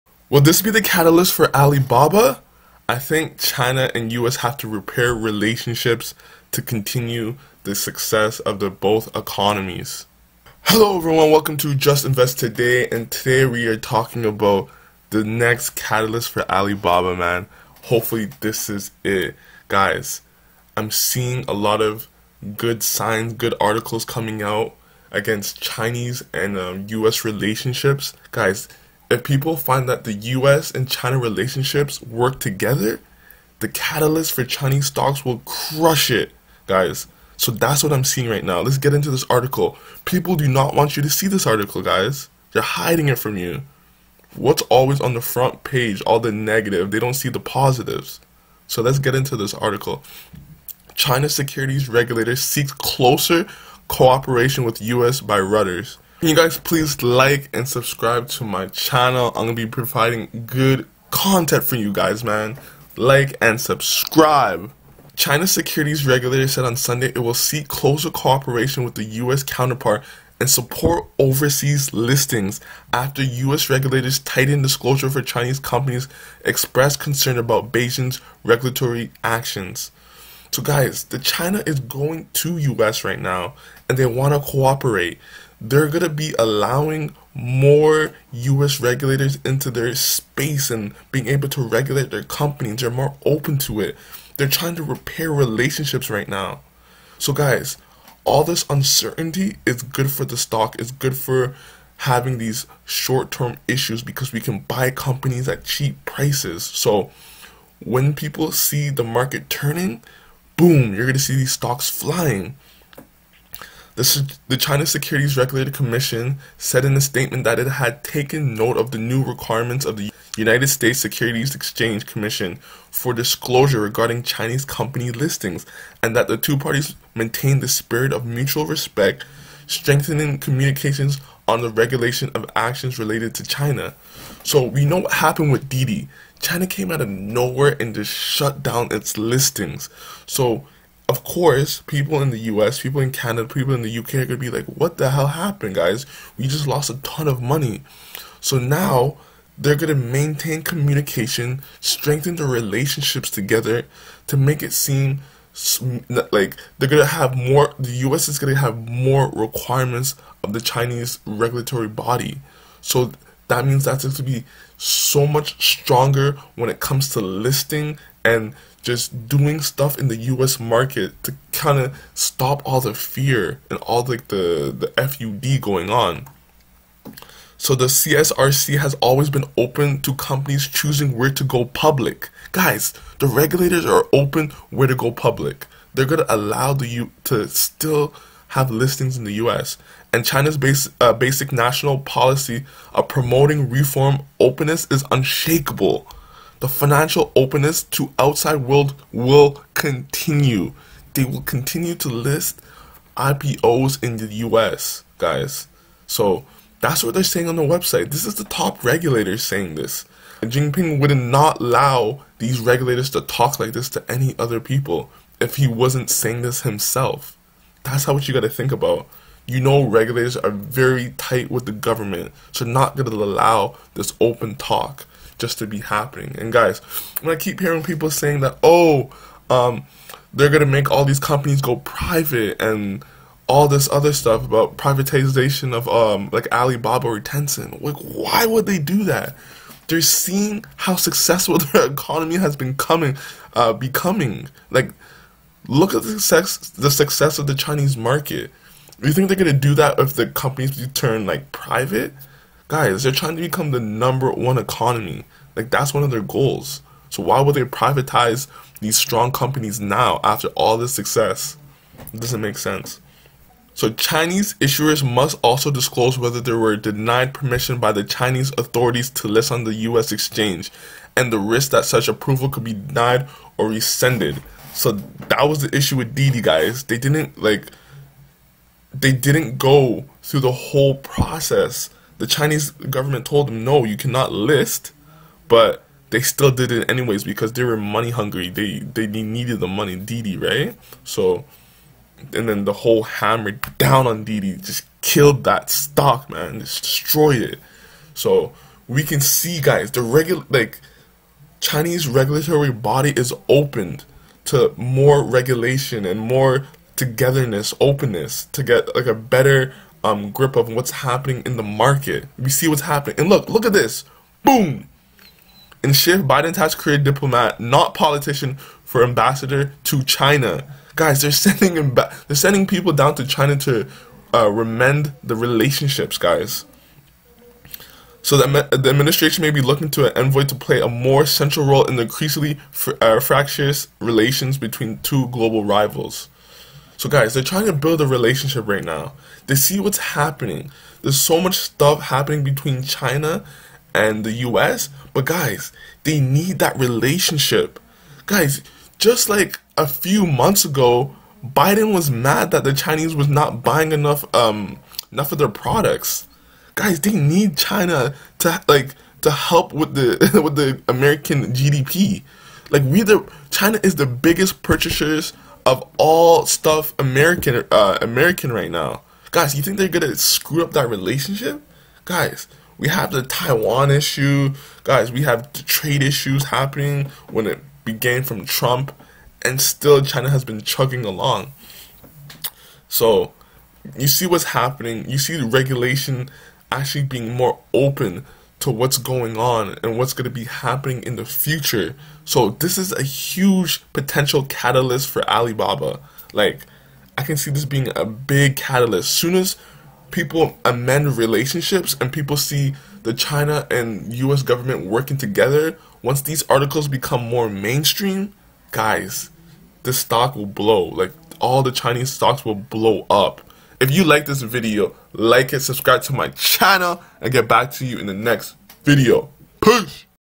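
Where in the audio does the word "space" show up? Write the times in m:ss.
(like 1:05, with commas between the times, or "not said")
1:29.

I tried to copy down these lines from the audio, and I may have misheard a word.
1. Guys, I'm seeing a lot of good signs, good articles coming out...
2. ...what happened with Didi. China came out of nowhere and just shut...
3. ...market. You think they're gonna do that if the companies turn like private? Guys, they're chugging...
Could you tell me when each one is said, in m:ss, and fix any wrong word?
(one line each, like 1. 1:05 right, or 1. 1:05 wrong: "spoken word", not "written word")
1. 0:19 right
2. 2:15 right
3. 4:07 wrong: "trying", not "chugging".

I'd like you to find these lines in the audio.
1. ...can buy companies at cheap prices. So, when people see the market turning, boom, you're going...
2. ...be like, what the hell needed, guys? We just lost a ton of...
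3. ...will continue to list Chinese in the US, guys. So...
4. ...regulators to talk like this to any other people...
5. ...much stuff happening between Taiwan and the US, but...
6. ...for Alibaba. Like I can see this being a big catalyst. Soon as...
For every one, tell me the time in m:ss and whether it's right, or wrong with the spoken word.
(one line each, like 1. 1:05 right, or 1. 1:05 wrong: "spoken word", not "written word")
1. 1:44 right
2. 2:24 wrong: "happened", not "needed"
3. 3:21 wrong: "IPOs", not "Chinese"
4. 3:32 right
5. 5:41 wrong: "China", not "Taiwan"
6. 6:35 right.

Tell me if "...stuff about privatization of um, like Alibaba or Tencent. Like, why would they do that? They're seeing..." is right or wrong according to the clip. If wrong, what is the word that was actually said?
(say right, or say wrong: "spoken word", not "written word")
right.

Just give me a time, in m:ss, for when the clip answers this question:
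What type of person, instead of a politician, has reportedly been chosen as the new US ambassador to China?
5:17.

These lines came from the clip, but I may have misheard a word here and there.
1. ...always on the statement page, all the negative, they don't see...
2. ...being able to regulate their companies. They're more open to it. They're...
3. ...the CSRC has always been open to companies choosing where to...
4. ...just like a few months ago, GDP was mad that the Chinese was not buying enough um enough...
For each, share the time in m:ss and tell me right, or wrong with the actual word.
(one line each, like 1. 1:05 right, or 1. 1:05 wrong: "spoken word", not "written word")
1. 0:44 wrong: "front", not "statement"
2. 1:31 right
3. 2:57 right
4. 5:48 wrong: "Biden", not "GDP".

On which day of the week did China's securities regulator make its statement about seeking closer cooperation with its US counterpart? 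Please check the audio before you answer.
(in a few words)
Sunday.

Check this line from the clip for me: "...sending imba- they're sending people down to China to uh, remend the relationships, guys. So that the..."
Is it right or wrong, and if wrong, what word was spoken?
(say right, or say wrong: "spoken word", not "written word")
right.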